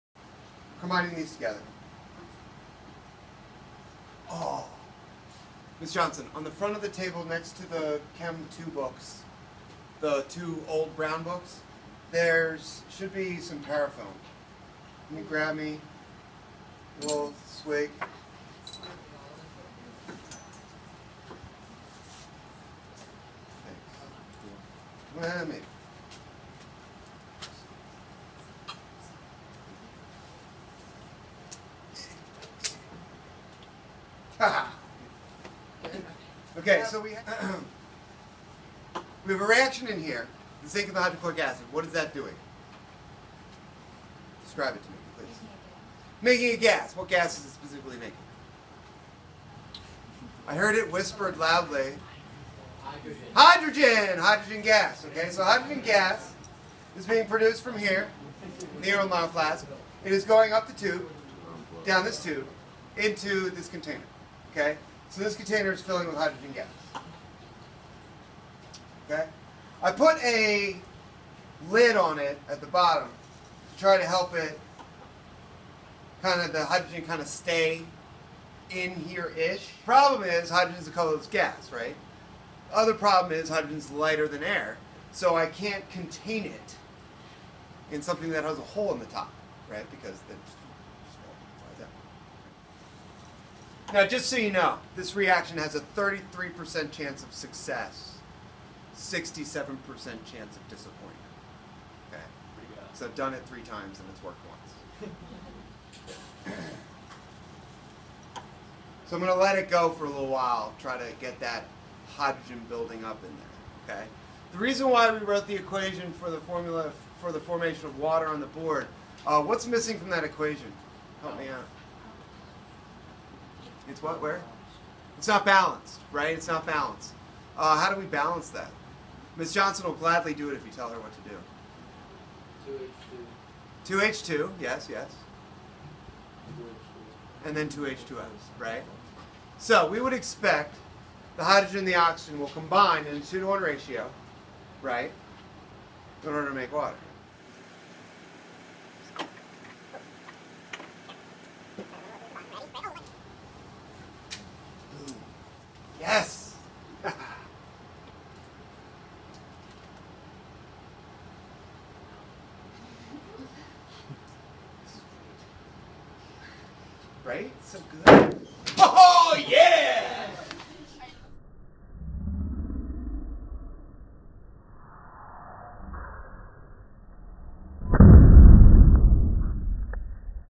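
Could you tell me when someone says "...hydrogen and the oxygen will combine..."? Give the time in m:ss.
2:21.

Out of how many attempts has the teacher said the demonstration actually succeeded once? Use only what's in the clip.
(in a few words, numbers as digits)
3.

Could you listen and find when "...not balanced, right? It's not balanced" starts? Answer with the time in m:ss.
2:05.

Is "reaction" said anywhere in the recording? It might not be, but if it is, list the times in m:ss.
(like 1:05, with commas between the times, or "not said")
0:39, 1:35.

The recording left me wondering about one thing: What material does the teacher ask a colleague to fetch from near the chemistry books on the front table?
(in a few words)
Parafilm.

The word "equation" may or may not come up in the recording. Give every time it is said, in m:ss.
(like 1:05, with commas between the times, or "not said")
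1:55, 2:00.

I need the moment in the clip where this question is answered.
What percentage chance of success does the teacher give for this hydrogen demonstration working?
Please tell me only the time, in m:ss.
1:35.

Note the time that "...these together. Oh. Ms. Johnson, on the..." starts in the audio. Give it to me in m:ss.
0:01.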